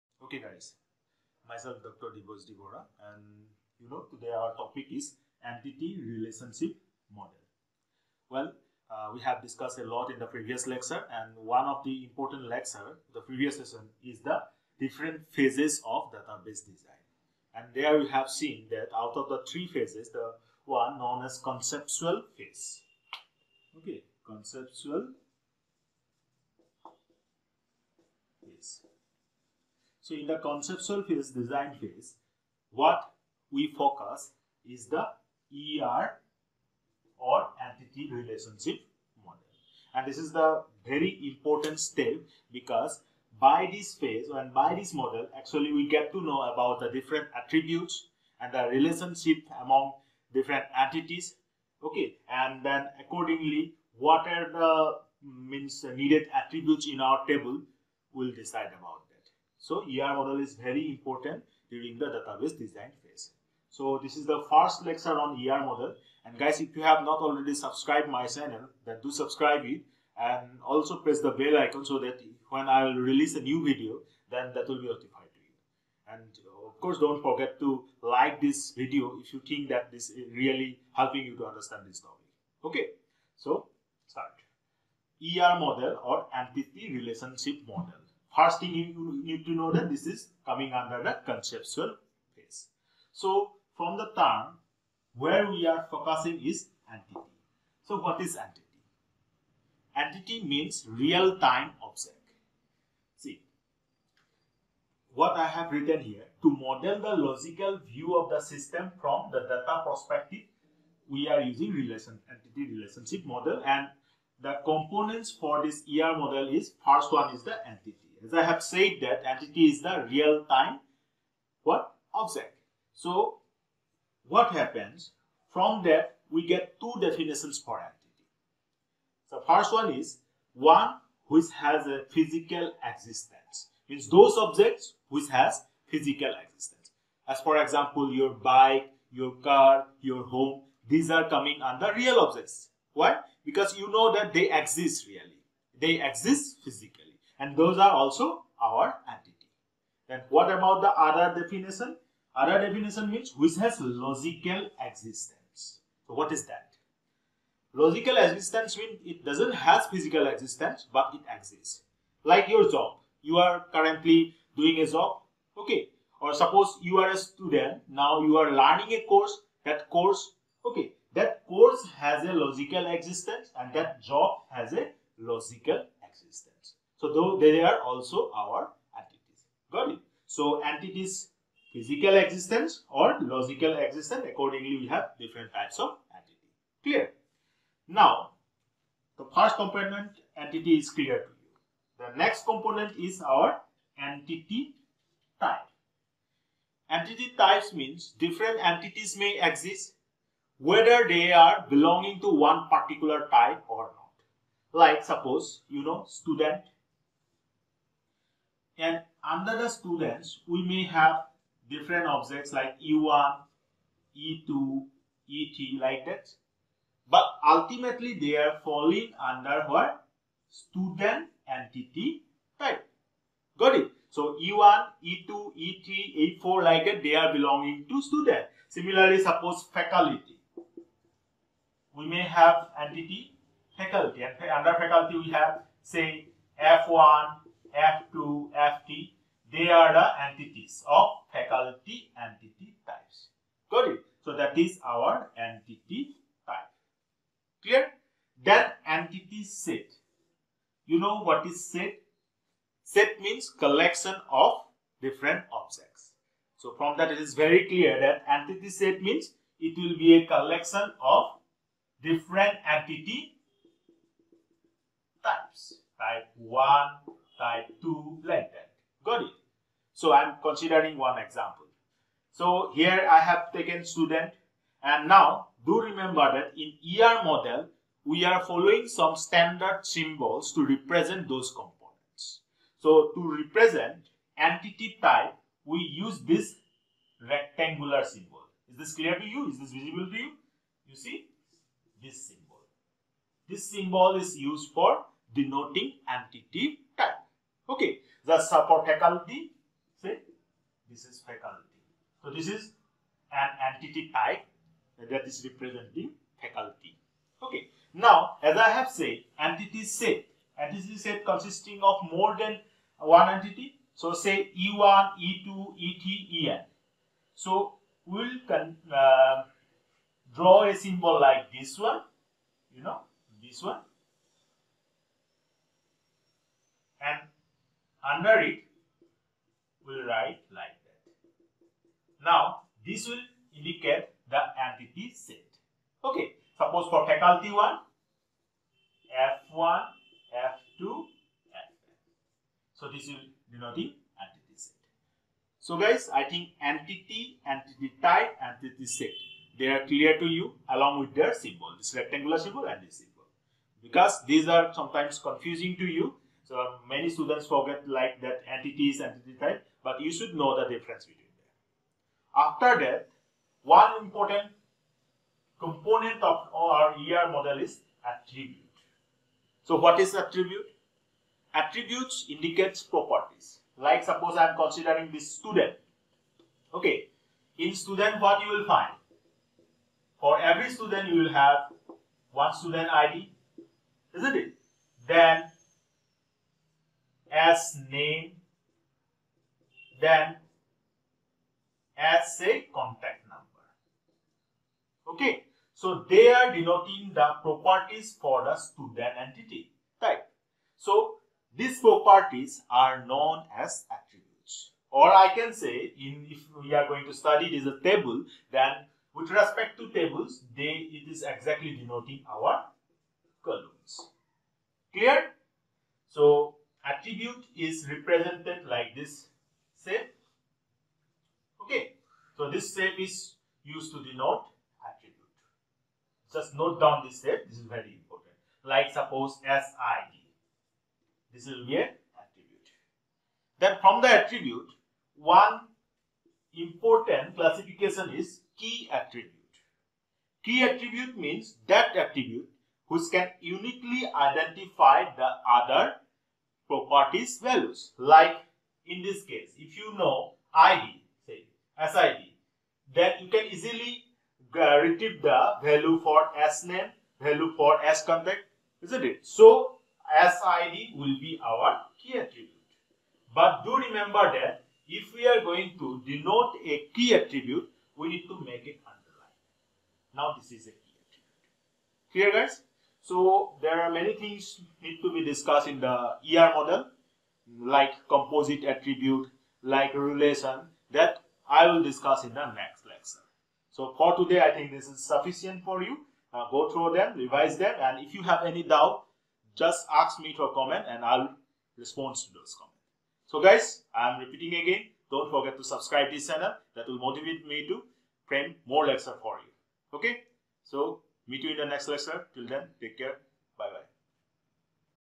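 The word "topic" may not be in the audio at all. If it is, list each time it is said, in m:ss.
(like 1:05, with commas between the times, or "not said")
0:04, 1:21.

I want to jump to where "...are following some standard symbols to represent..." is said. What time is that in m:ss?
4:38.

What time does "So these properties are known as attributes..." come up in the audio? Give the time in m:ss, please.
6:40.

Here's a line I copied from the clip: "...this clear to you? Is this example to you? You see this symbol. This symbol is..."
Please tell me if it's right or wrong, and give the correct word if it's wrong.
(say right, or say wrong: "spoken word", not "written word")
wrong: "visible", not "example".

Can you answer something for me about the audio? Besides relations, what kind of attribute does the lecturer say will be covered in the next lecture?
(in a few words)
Composite attribute.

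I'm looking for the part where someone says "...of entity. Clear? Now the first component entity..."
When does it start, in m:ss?
3:05.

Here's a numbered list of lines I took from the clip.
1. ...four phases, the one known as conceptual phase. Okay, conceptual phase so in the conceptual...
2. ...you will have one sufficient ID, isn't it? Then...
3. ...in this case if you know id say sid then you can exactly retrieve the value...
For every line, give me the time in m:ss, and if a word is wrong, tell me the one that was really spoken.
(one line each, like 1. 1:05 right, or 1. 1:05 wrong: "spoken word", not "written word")
1. 0:19 wrong: "three", not "four"
2. 6:21 wrong: "student", not "sufficient"
3. 7:28 wrong: "easily", not "exactly".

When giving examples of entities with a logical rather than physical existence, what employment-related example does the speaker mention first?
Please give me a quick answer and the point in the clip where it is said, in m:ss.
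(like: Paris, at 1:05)
Your job, at 2:42.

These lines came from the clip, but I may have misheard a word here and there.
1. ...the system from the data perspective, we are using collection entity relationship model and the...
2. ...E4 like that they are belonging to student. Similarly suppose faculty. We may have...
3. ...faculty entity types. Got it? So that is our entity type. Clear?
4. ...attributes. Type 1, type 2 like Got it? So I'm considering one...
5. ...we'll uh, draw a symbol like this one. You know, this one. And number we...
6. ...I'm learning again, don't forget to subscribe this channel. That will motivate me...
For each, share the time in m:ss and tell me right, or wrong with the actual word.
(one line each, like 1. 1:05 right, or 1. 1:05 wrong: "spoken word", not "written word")
1. 1:48 wrong: "relation", not "collection"
2. 3:46 right
3. 4:01 right
4. 4:25 wrong: "types", not "attributes"
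5. 5:18 wrong: "under", not "number"
6. 8:13 wrong: "repeating", not "learning".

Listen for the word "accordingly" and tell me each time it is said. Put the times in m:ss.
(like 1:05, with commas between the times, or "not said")
0:52, 3:04.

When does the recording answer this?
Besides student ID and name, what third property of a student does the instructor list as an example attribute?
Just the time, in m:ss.
6:32.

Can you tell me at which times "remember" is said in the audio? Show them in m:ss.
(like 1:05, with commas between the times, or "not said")
4:35, 7:43.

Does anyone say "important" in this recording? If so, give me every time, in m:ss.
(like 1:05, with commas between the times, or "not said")
0:12, 0:41, 1:00, 6:04, 7:08, 7:16.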